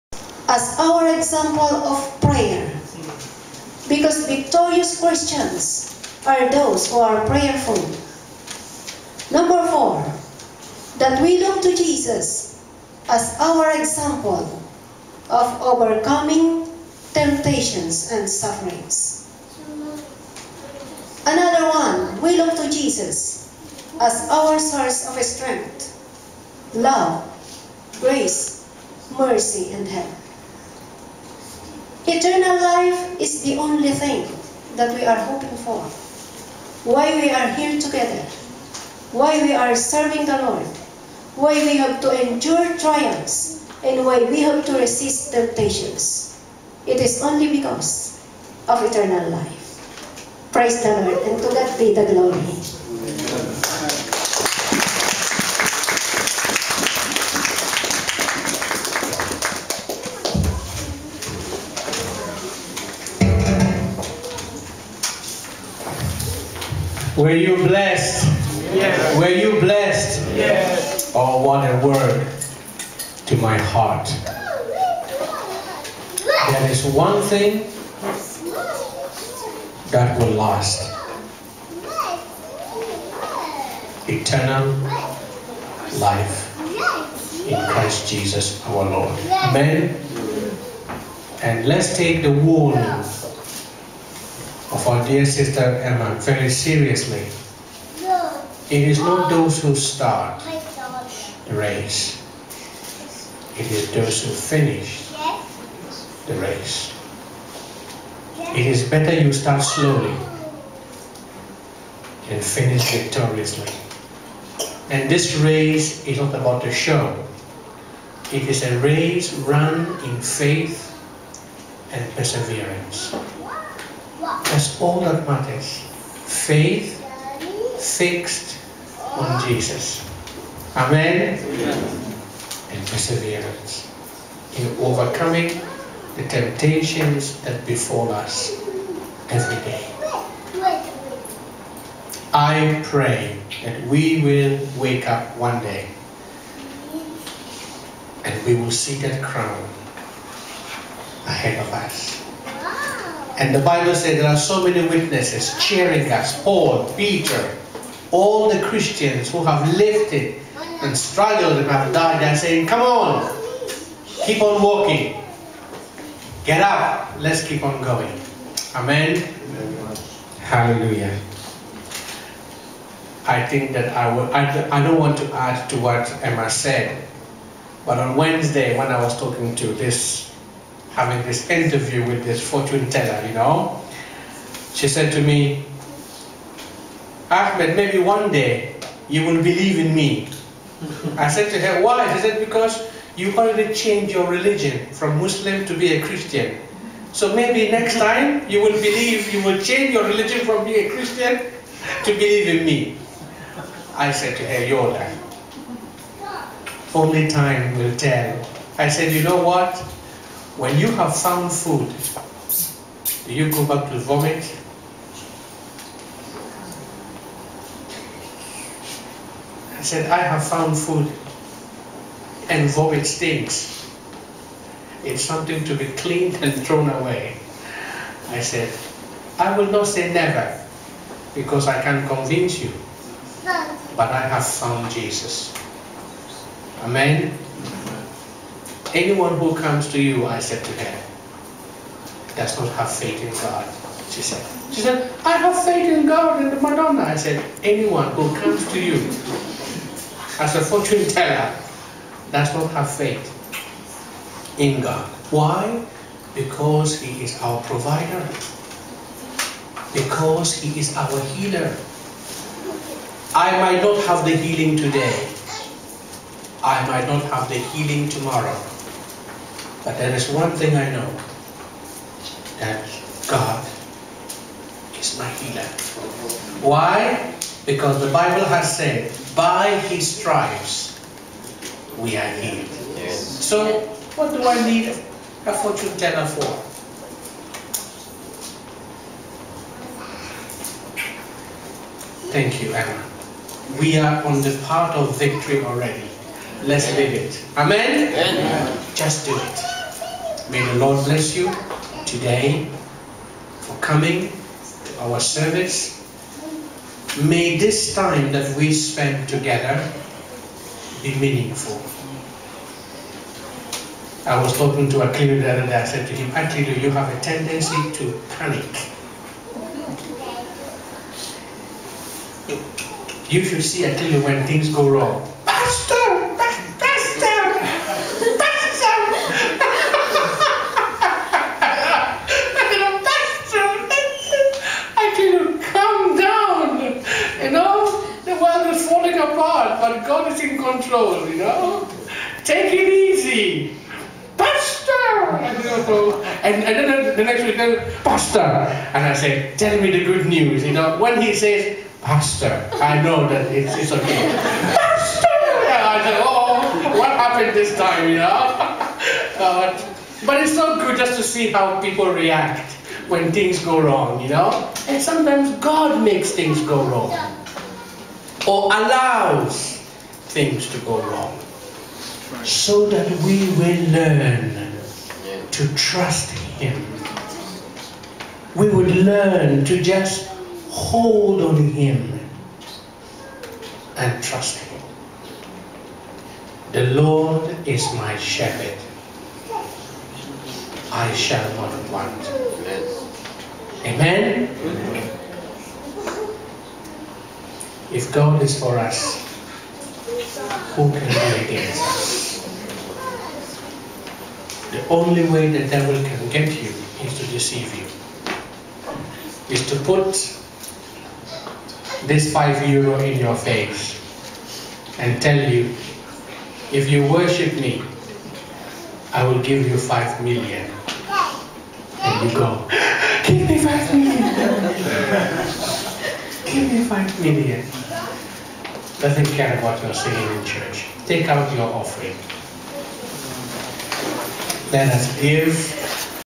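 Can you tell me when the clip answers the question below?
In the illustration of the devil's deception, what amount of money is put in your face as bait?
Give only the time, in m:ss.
6:52.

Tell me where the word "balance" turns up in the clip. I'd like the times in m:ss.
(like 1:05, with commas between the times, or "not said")
not said.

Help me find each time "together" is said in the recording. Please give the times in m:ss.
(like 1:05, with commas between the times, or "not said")
0:37, 5:09.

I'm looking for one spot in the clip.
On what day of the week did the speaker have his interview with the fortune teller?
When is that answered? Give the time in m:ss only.
2:58.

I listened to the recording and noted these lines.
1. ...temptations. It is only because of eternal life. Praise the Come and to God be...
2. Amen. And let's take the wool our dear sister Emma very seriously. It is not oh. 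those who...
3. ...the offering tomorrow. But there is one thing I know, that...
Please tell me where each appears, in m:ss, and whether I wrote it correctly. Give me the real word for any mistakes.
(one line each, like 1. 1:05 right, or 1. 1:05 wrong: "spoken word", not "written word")
1. 0:45 wrong: "Lord", not "Come"
2. 1:29 right
3. 4:27 wrong: "healing", not "offering".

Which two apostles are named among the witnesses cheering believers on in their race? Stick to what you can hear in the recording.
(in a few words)
Paul, Peter.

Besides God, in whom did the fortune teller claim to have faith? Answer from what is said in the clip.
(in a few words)
the Madonna.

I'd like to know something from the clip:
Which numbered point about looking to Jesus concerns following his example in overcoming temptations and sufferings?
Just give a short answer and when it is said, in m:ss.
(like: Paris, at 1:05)
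4, at 0:09.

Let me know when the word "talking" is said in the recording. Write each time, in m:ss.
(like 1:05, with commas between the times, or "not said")
2:59, 5:14.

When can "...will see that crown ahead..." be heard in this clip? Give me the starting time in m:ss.
2:28.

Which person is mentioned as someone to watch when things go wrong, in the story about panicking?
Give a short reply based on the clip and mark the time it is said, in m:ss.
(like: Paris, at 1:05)
Akilu, at 5:23.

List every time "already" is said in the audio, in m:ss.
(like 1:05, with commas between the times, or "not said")
3:13, 4:55.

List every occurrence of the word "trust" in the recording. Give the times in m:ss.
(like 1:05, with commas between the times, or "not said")
6:15, 6:24.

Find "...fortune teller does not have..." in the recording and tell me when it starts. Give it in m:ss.
4:10.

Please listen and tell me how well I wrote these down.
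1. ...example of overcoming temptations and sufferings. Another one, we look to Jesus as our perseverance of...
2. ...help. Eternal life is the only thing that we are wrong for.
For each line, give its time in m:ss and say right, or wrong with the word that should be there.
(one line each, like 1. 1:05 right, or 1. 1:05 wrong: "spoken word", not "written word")
1. 0:13 wrong: "source", not "perseverance"
2. 0:29 wrong: "hoping", not "wrong".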